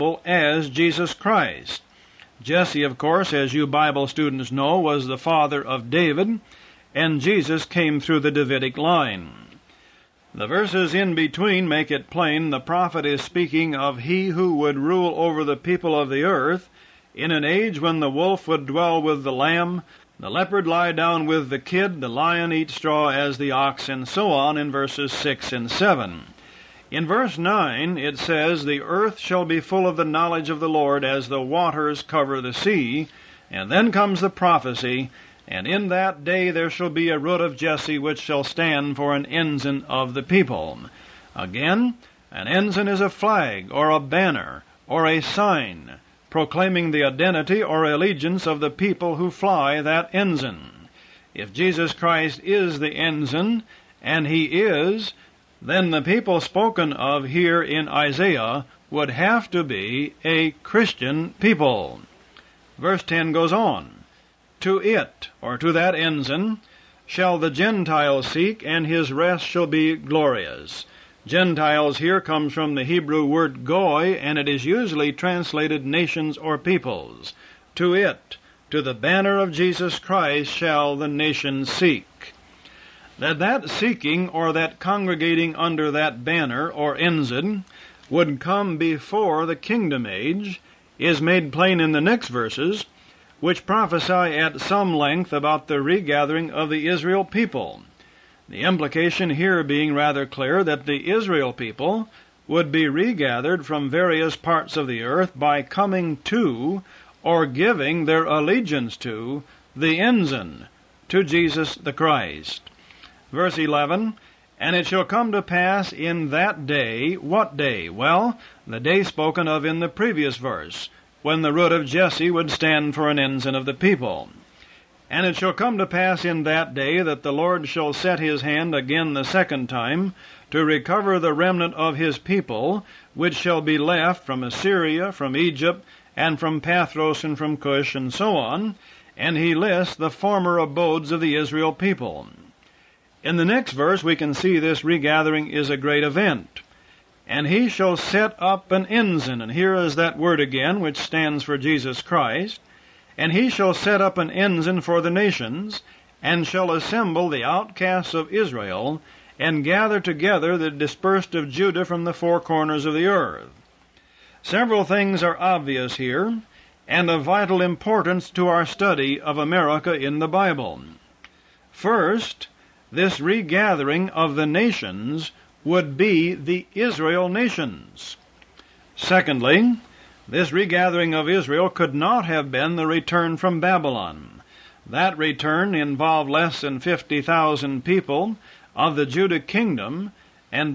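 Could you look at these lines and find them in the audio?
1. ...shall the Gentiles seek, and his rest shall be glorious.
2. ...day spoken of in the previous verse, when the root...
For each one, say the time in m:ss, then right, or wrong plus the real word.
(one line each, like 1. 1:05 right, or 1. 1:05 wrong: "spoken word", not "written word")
1. 1:07 right
2. 1:58 right.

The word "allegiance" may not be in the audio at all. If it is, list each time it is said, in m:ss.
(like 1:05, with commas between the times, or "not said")
0:47, 1:48.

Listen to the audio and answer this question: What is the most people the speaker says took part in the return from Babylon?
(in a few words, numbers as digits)
less than 50,000.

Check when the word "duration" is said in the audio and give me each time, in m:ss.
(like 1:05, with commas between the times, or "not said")
not said.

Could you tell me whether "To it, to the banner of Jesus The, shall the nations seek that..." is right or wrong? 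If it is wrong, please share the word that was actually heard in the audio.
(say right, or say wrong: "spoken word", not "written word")
wrong: "Christ", not "The".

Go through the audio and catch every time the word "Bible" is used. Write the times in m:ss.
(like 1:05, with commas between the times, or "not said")
0:03, 2:50.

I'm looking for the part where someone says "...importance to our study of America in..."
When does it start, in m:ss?
2:47.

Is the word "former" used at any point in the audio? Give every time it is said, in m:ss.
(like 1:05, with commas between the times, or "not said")
2:20.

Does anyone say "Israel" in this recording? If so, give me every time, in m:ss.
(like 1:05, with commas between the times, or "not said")
1:36, 1:41, 2:21, 2:38, 2:56, 3:01.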